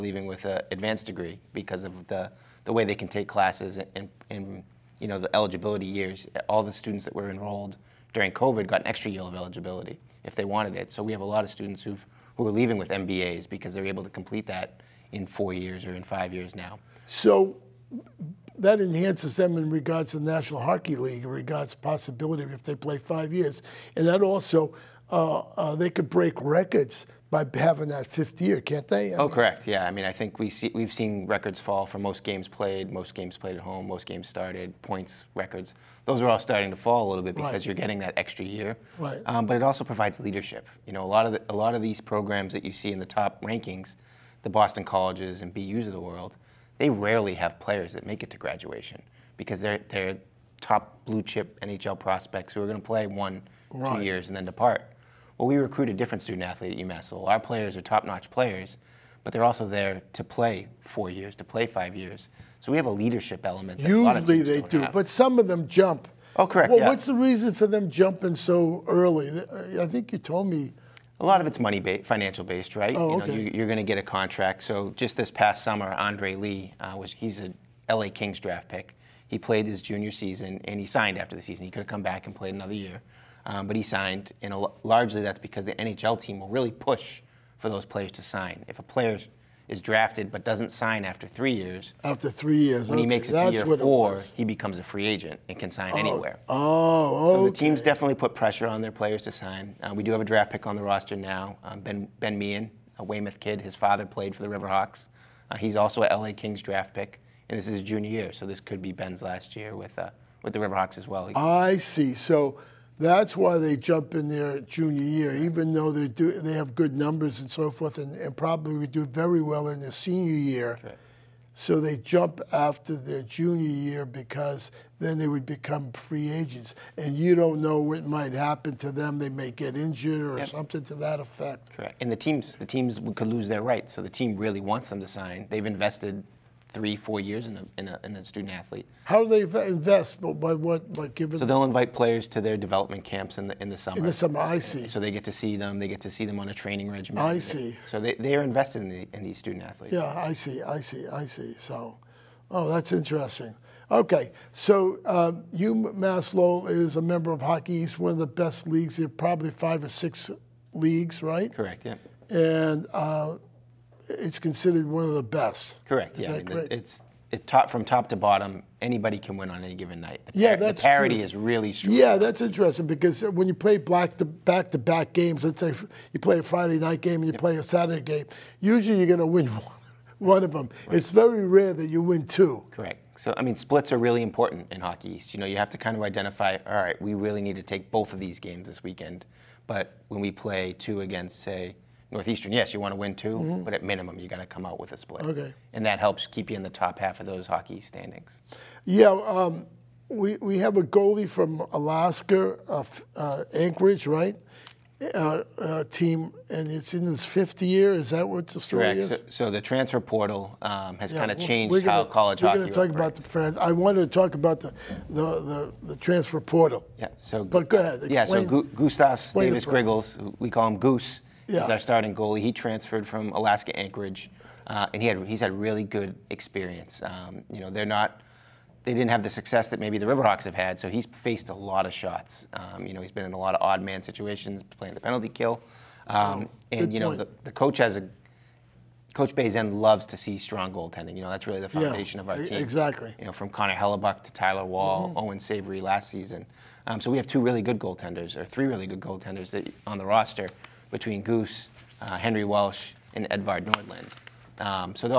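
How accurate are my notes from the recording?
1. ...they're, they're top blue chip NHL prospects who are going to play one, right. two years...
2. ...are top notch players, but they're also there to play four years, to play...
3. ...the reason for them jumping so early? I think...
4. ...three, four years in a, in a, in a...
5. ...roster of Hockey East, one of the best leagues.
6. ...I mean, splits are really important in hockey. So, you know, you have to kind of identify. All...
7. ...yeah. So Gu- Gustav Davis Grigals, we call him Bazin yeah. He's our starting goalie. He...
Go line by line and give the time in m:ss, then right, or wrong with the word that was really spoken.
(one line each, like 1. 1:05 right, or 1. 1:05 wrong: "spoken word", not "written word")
1. 0:49 right
2. 0:57 right
3. 1:07 right
4. 2:16 right
5. 2:37 wrong: "member", not "roster"
6. 3:03 right
7. 3:38 wrong: "Goose", not "Bazin".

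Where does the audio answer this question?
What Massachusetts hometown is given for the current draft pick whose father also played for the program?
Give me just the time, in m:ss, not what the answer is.
1:43.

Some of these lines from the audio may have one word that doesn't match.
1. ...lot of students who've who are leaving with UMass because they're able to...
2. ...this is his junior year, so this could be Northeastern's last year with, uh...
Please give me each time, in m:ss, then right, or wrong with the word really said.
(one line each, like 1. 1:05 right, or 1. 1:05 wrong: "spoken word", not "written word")
1. 0:11 wrong: "MBAs", not "UMass"
2. 1:47 wrong: "Ben", not "Northeastern".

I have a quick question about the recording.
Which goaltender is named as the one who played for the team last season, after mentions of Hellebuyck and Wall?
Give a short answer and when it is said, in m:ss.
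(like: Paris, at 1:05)
Owen Savory, at 4:05.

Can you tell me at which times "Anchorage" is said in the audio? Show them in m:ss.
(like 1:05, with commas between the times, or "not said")
3:23, 3:43.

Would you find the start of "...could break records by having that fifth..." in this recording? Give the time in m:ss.
0:25.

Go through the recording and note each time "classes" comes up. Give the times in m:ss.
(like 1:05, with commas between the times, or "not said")
0:03.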